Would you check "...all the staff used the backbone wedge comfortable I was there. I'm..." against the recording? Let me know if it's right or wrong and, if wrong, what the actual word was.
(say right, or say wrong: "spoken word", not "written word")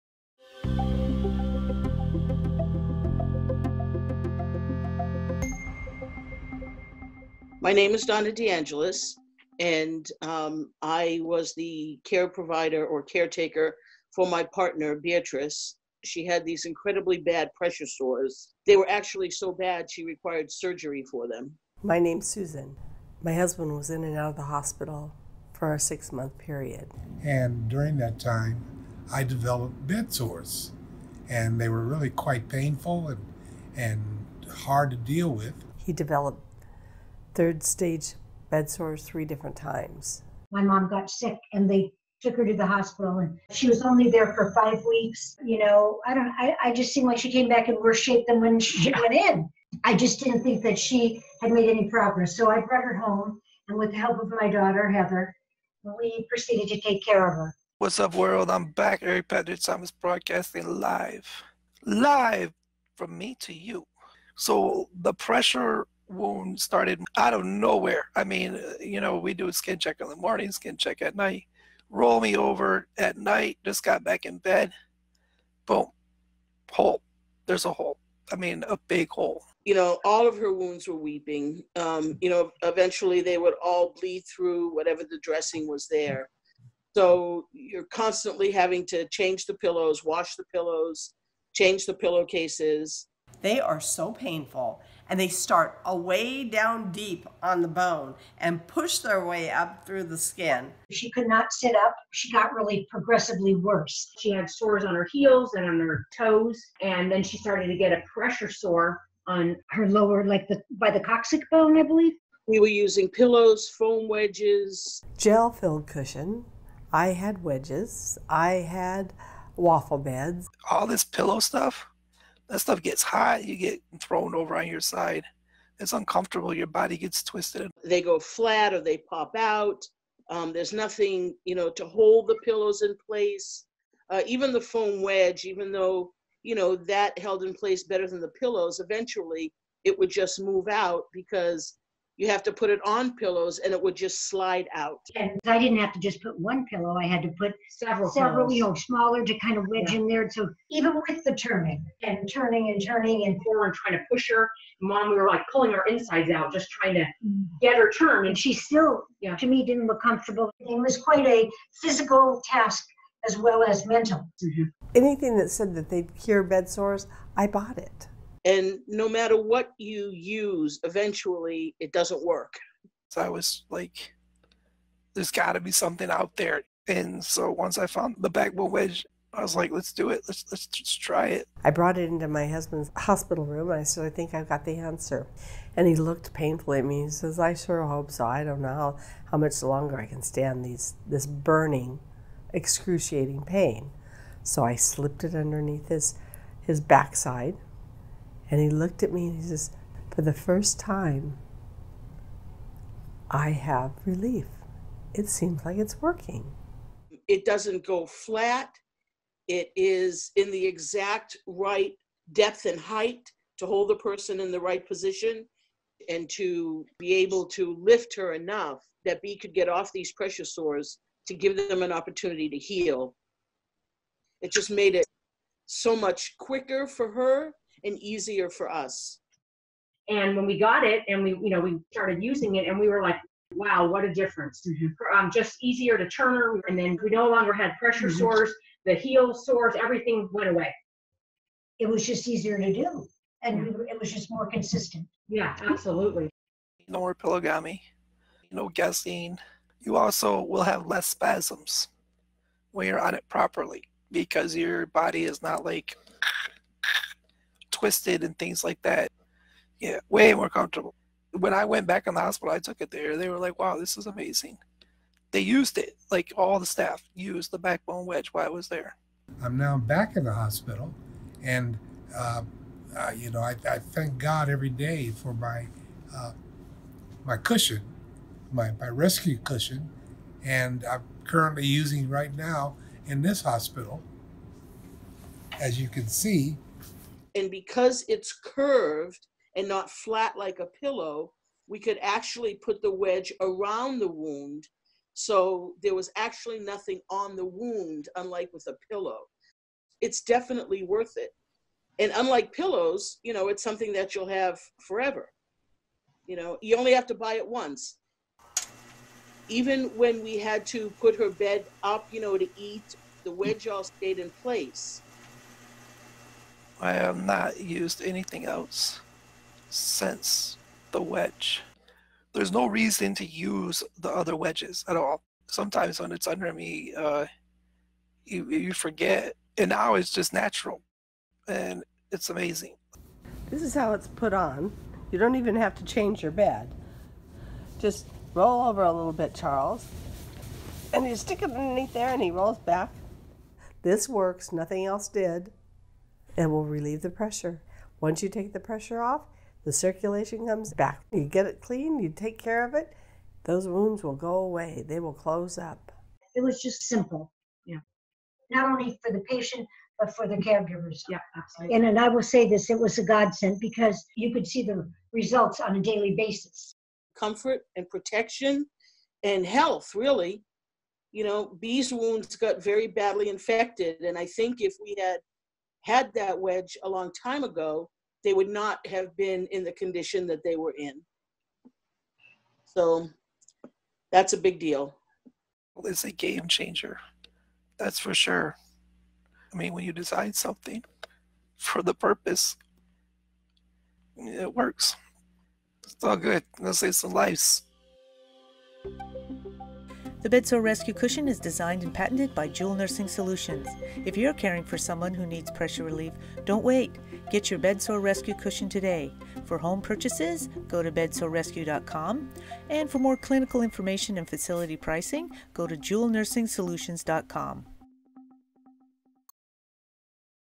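wrong: "while", not "comfortable".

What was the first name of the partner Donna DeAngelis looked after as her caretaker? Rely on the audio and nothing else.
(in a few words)
Beatrice.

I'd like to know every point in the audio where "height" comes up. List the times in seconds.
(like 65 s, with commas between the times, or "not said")
212 s.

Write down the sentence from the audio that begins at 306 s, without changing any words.
You know, you only have to buy it once.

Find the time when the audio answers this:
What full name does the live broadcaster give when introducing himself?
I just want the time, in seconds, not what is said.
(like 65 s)
59 s.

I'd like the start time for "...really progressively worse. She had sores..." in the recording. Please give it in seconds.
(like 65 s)
102 s.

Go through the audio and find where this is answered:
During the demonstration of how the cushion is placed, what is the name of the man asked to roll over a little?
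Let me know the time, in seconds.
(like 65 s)
339 s.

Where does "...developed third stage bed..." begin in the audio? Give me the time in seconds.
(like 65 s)
35 s.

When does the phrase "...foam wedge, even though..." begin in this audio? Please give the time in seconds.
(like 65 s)
134 s.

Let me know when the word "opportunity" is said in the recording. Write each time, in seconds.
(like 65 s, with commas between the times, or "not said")
221 s.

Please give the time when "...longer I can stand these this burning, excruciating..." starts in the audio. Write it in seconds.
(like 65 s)
189 s.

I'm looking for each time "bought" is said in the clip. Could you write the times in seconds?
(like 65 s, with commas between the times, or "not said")
167 s.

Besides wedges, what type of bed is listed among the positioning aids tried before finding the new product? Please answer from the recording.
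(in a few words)
Waffle beds.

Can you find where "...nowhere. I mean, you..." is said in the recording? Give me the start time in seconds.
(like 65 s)
67 s.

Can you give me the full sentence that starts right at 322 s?
There's no reason to use the other wedges at all.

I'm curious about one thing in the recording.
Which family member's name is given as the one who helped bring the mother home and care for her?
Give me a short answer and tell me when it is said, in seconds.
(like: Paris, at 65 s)
Heather, at 54 s.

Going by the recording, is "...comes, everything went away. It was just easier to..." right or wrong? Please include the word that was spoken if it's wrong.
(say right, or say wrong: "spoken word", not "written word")
wrong: "sores", not "comes".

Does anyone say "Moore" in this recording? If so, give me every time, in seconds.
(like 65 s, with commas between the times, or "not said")
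not said.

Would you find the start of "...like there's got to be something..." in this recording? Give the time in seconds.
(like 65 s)
173 s.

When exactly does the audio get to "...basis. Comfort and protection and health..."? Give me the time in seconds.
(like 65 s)
366 s.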